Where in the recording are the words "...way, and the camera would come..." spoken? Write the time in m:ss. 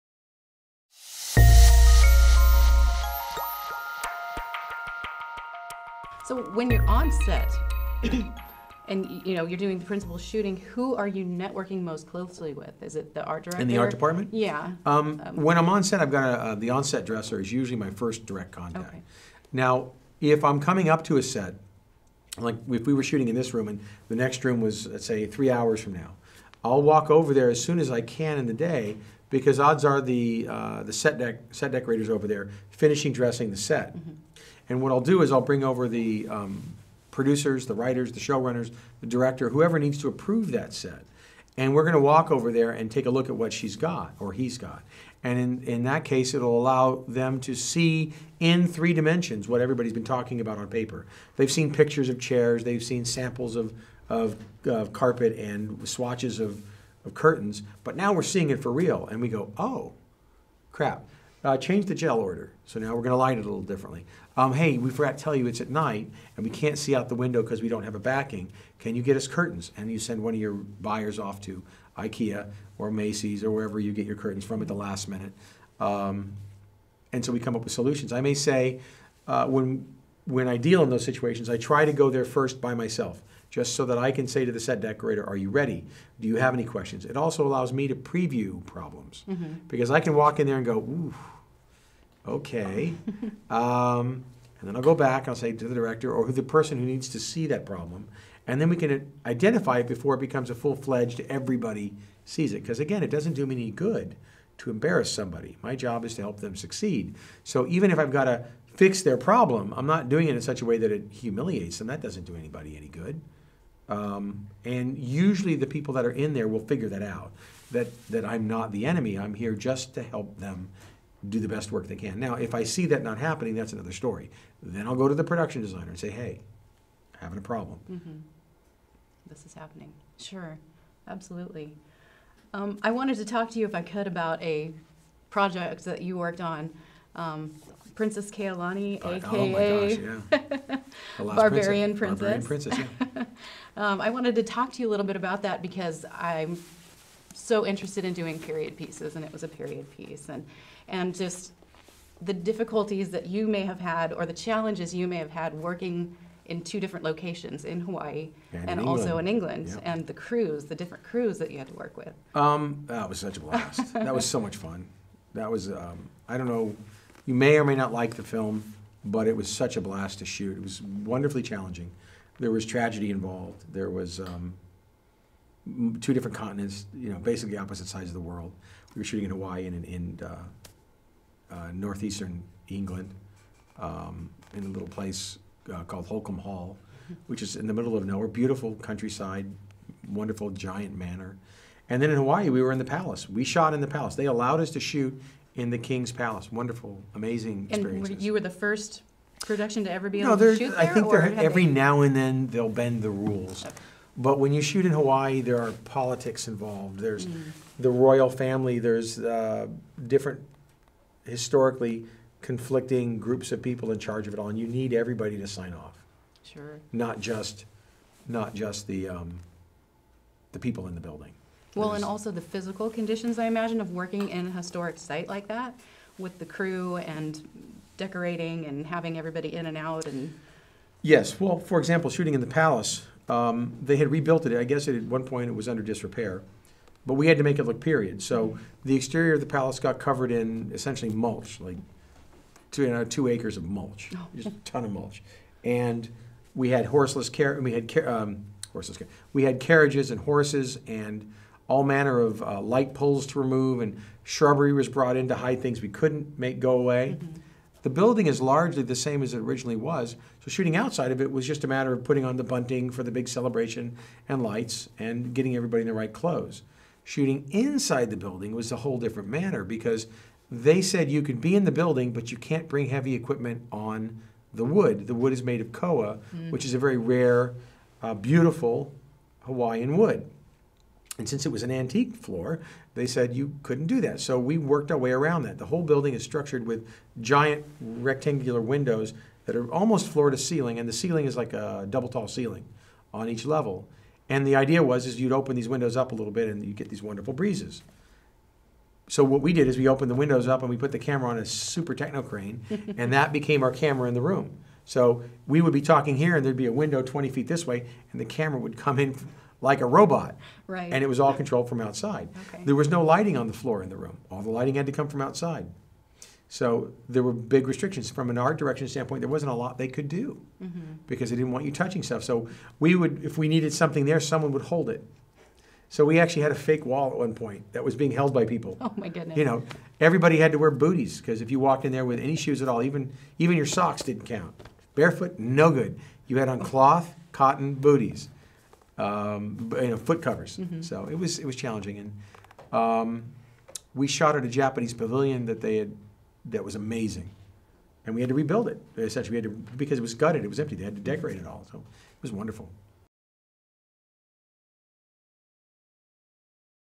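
5:07.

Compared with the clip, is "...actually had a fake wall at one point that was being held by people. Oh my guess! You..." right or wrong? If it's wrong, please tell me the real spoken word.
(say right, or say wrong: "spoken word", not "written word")
wrong: "goodness", not "guess".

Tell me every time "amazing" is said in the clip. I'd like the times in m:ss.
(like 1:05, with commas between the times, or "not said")
3:17, 5:46.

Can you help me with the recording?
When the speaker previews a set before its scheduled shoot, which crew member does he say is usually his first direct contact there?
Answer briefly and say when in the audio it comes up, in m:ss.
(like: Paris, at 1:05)
On-set dresser, at 0:16.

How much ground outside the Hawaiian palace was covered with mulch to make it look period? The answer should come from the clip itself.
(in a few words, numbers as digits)
2 acres.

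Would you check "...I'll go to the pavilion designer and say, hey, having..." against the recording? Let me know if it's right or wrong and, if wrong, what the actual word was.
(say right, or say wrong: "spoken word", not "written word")
wrong: "production", not "pavilion".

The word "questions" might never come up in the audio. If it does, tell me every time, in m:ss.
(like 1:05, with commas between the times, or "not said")
1:26.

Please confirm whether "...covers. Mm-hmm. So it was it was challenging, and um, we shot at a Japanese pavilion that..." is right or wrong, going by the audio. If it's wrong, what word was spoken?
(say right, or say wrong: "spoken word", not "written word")
right.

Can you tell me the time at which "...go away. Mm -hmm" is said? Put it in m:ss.
4:16.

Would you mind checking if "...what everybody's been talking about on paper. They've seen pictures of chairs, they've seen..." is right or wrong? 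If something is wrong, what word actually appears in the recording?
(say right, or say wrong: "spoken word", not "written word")
right.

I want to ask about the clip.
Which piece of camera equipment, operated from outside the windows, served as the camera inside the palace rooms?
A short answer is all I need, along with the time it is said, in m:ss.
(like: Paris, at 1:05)
Super techno crane, at 5:01.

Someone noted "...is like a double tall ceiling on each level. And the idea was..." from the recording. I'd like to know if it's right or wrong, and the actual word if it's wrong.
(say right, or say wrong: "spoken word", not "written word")
right.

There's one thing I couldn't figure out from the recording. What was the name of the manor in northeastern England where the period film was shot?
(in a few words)
Holcombe Hall.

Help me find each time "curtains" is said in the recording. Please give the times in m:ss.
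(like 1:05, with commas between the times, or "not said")
0:57, 1:09, 1:14.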